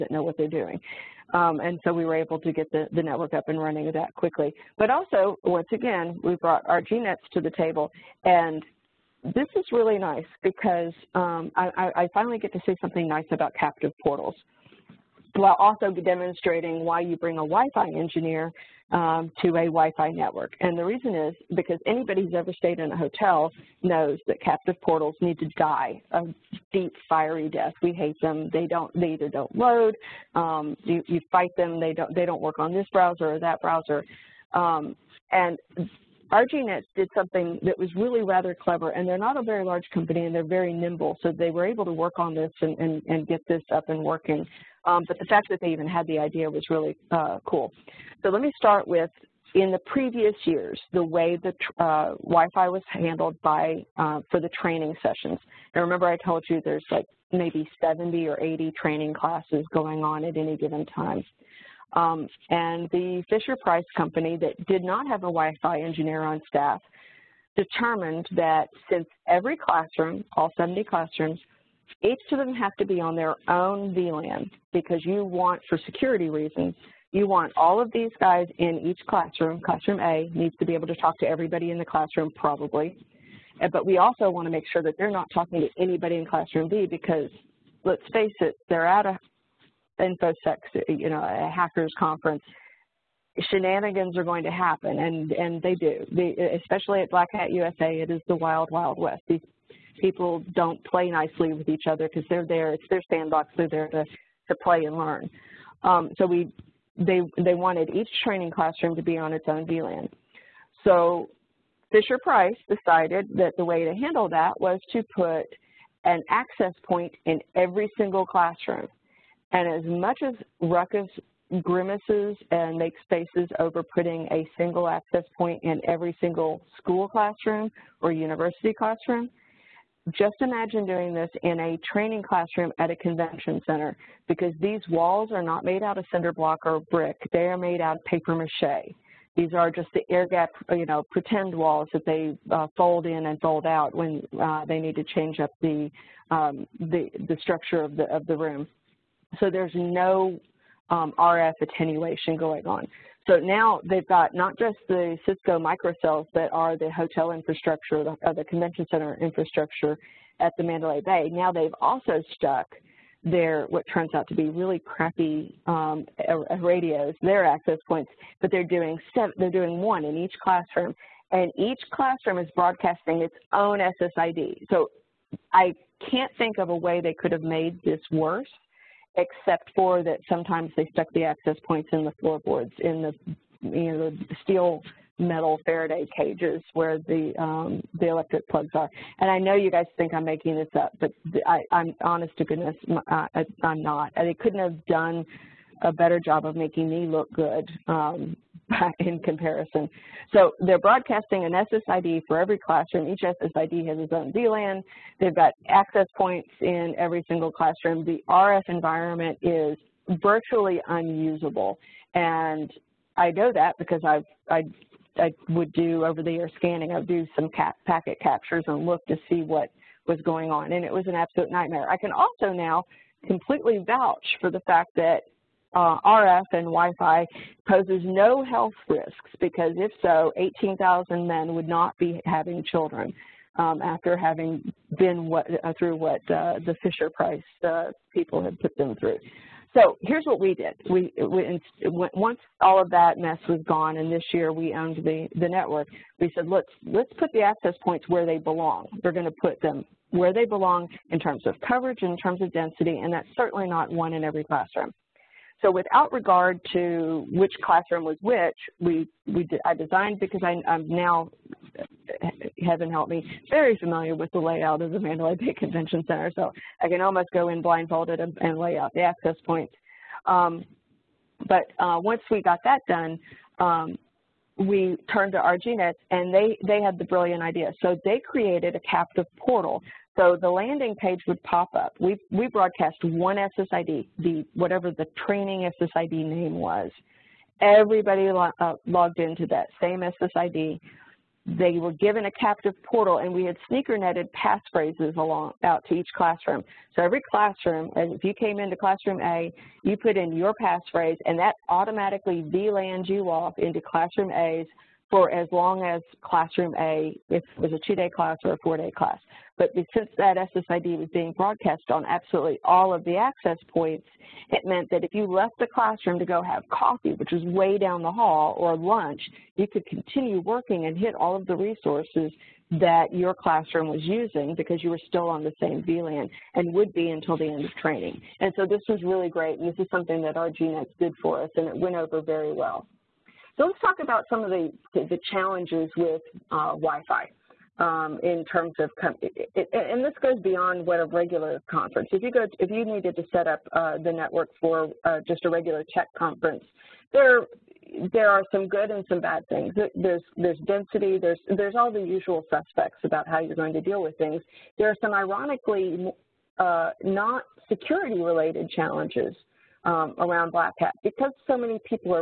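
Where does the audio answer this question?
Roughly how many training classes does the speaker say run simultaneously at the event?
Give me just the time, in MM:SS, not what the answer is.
00:57.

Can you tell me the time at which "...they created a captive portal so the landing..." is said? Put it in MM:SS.
04:38.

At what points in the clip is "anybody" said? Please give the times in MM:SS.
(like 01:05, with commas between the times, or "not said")
00:21, 01:25.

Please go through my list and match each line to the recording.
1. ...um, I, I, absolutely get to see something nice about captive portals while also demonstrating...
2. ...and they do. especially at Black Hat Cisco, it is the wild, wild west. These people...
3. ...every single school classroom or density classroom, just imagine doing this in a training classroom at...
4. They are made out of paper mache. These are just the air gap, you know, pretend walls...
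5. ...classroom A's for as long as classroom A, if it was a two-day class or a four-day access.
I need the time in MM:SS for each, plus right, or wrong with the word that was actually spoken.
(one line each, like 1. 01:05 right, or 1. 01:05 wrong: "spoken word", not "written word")
1. 00:11 wrong: "finally", not "absolutely"
2. 01:35 wrong: "USA", not "Cisco"
3. 02:05 wrong: "university", not "density"
4. 02:17 right
5. 05:03 wrong: "class", not "access".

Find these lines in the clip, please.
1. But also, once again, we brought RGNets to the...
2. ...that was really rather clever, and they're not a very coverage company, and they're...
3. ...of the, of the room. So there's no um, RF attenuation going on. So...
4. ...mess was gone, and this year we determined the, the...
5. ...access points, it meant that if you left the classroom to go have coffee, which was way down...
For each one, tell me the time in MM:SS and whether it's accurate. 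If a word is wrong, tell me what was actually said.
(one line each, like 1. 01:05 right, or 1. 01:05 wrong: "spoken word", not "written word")
1. 00:04 right
2. 00:37 wrong: "large", not "coverage"
3. 02:27 right
4. 04:03 wrong: "owned", not "determined"
5. 05:13 right.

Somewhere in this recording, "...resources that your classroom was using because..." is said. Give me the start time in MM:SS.
05:21.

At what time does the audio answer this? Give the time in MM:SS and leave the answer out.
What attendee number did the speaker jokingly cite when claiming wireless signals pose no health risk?
03:50.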